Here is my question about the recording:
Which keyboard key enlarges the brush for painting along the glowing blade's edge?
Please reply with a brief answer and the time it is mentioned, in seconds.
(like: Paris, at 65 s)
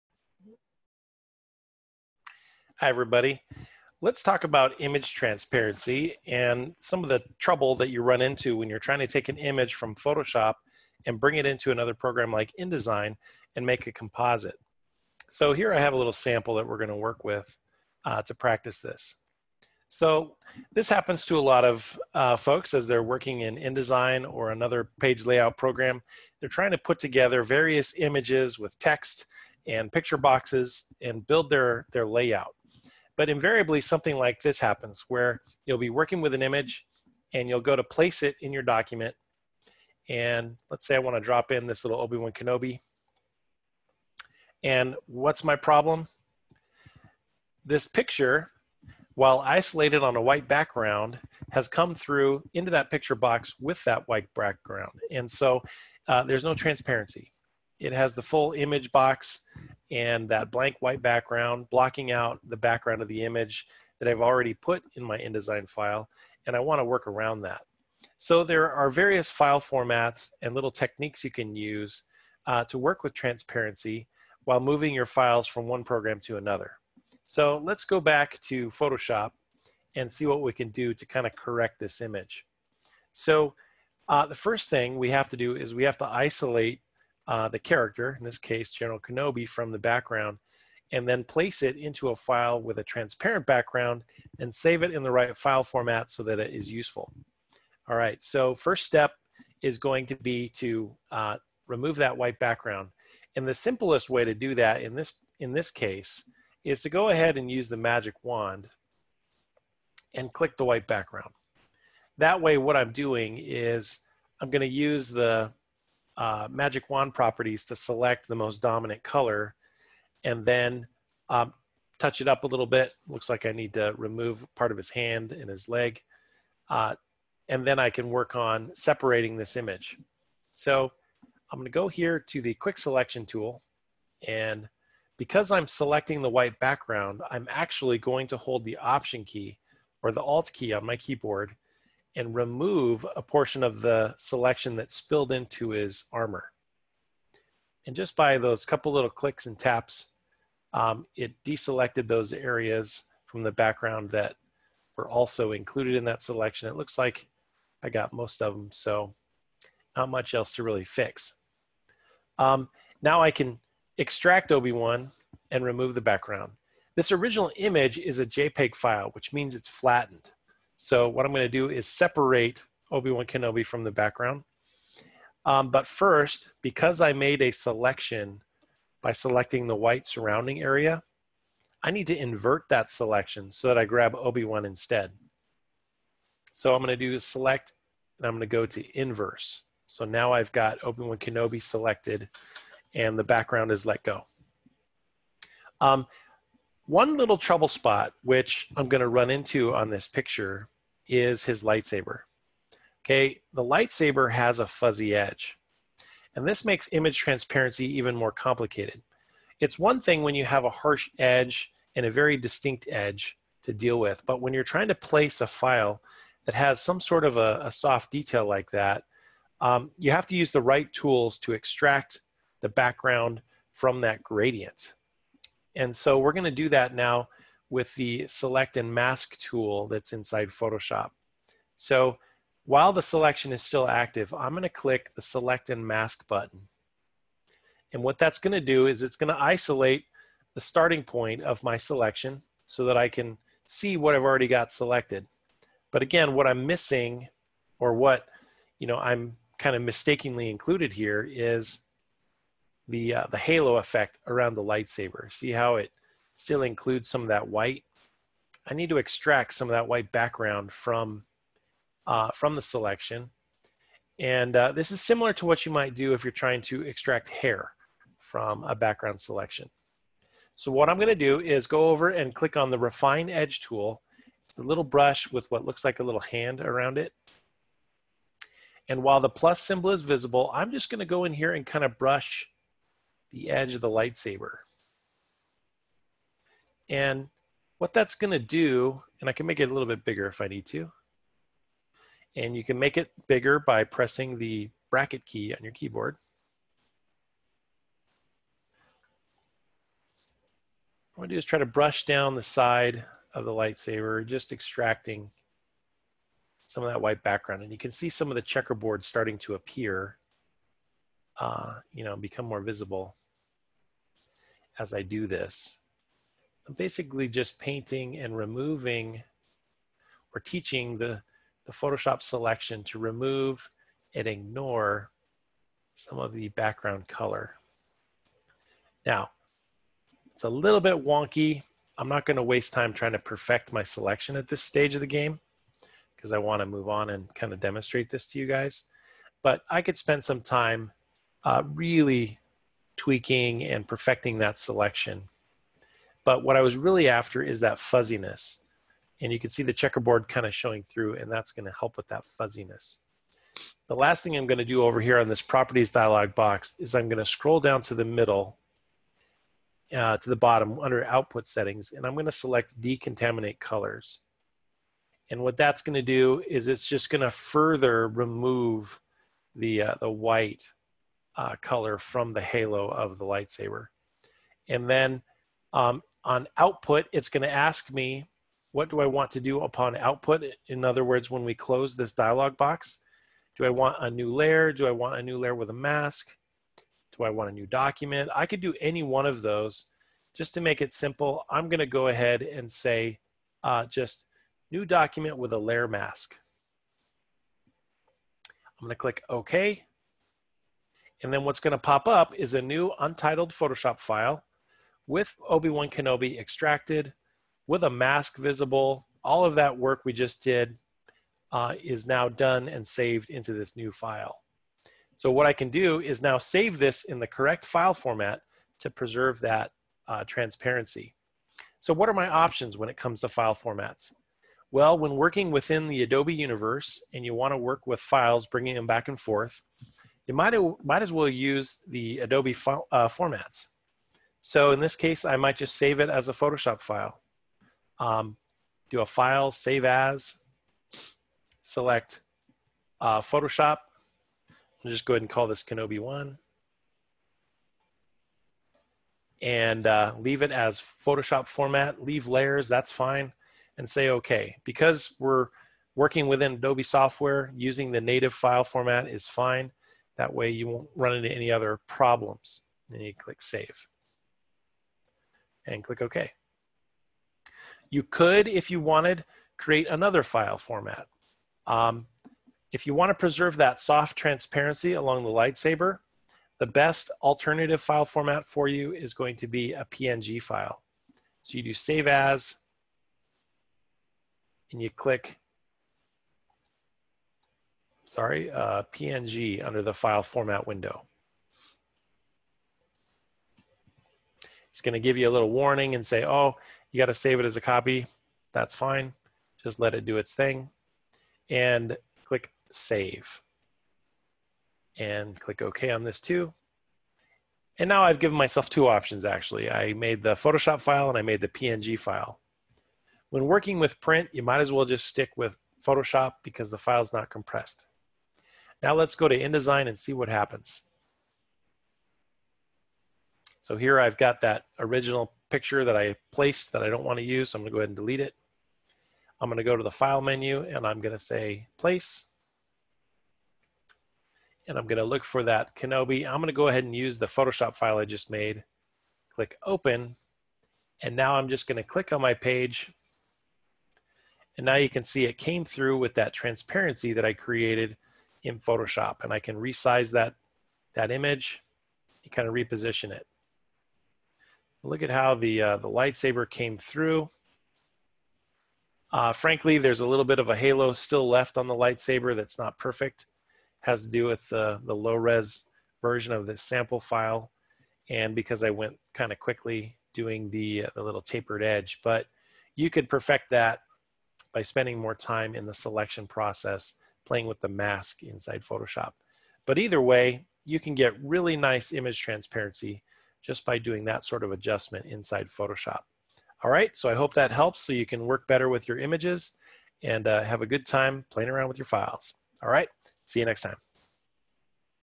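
bracket key, at 294 s.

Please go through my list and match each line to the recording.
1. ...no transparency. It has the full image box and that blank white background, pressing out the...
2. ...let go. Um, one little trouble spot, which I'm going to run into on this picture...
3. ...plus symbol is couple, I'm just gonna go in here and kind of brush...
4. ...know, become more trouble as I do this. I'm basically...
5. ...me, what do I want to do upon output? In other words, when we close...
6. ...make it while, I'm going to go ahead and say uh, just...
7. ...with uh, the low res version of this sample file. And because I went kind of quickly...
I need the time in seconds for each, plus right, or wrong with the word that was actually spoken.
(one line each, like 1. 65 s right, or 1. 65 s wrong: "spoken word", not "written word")
1. 56 s wrong: "blocking", not "pressing"
2. 193 s right
3. 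279 s wrong: "visible", not "couple"
4. 312 s wrong: "visible", not "trouble"
5. 377 s right
6. 390 s wrong: "simple", not "while"
7. 564 s right.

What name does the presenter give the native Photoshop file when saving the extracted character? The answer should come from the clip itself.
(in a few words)
Kenobi 1.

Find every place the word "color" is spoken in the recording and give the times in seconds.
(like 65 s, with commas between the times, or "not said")
119 s, 327 s, 363 s, 371 s.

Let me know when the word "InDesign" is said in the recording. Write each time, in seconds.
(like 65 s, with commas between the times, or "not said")
12 s, 23 s, 65 s, 519 s.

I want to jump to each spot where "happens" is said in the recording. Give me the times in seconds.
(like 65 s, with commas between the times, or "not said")
20 s, 34 s, 520 s.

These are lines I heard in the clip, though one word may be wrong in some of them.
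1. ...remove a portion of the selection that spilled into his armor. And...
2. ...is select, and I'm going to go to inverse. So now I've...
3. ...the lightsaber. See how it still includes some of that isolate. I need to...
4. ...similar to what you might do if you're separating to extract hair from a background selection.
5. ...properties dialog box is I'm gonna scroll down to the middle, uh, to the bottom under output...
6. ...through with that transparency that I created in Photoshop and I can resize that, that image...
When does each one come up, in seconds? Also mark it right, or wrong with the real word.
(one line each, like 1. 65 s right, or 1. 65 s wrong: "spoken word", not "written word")
1. 142 s right
2. 187 s right
3. 254 s wrong: "white", not "isolate"
4. 265 s wrong: "trying", not "separating"
5. 355 s right
6. 545 s right.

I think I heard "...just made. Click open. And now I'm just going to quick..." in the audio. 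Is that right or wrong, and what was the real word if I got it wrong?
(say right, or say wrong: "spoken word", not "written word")
wrong: "click", not "quick".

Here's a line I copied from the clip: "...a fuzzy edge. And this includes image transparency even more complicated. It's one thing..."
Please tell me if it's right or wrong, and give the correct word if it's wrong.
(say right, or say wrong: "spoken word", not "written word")
wrong: "makes", not "includes".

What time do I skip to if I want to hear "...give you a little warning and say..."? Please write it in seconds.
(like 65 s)
494 s.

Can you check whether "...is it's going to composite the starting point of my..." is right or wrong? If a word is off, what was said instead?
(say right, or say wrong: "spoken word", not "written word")
wrong: "isolate", not "composite".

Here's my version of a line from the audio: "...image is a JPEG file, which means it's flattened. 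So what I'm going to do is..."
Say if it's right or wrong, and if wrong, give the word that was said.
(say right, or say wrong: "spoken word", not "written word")
right.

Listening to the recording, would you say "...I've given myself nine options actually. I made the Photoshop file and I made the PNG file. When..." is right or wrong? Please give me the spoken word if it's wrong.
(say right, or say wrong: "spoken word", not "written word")
wrong: "two", not "nine".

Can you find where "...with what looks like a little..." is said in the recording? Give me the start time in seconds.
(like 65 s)
275 s.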